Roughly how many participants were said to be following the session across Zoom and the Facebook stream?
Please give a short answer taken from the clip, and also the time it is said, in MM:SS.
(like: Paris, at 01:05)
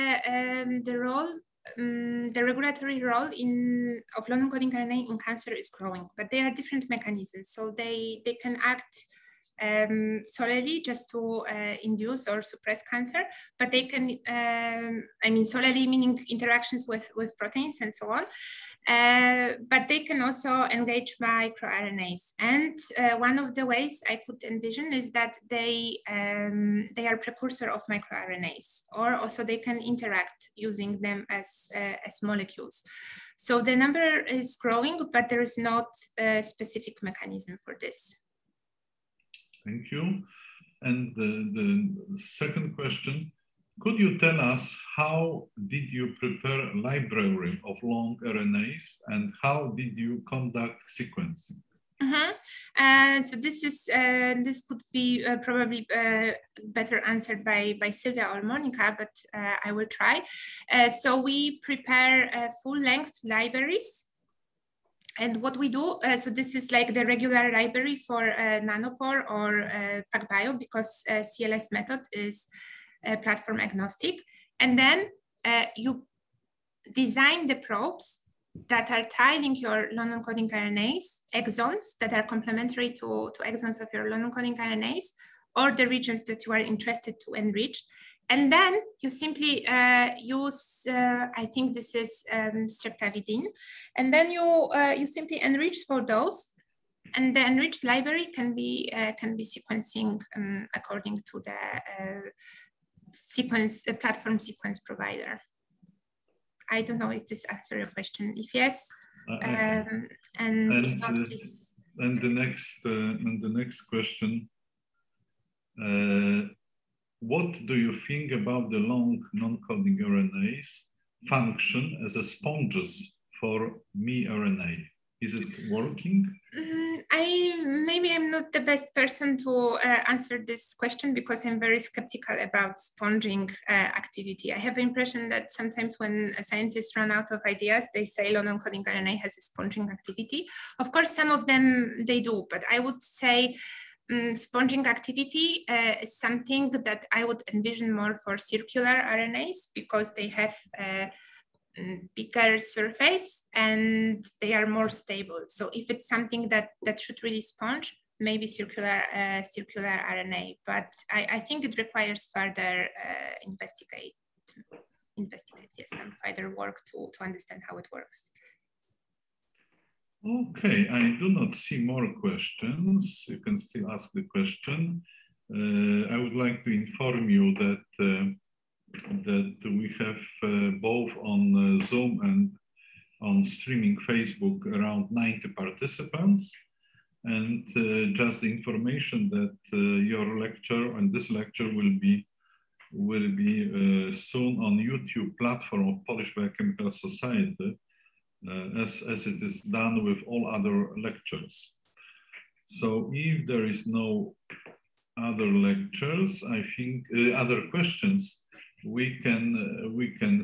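90, at 03:05.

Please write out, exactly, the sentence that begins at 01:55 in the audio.
Uh, what do you think about the long non-coding RNAs function as a sponges for miRNA?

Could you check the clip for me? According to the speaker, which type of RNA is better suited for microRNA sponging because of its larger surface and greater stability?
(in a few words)
Circular RNAs.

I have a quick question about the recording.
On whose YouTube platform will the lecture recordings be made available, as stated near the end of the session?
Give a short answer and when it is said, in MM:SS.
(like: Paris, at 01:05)
Polish Biochemical Society, at 03:16.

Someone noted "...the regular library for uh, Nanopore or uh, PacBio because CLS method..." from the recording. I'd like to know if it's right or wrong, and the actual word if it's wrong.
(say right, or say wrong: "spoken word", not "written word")
right.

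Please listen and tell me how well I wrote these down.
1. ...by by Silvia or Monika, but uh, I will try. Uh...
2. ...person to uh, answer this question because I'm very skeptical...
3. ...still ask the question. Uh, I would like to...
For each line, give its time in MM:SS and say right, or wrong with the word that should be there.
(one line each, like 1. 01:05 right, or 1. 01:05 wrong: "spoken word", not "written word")
1. 00:57 right
2. 02:08 right
3. 02:53 right.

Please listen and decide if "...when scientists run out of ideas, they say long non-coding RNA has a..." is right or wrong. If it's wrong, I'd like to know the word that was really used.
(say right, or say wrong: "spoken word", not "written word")
right.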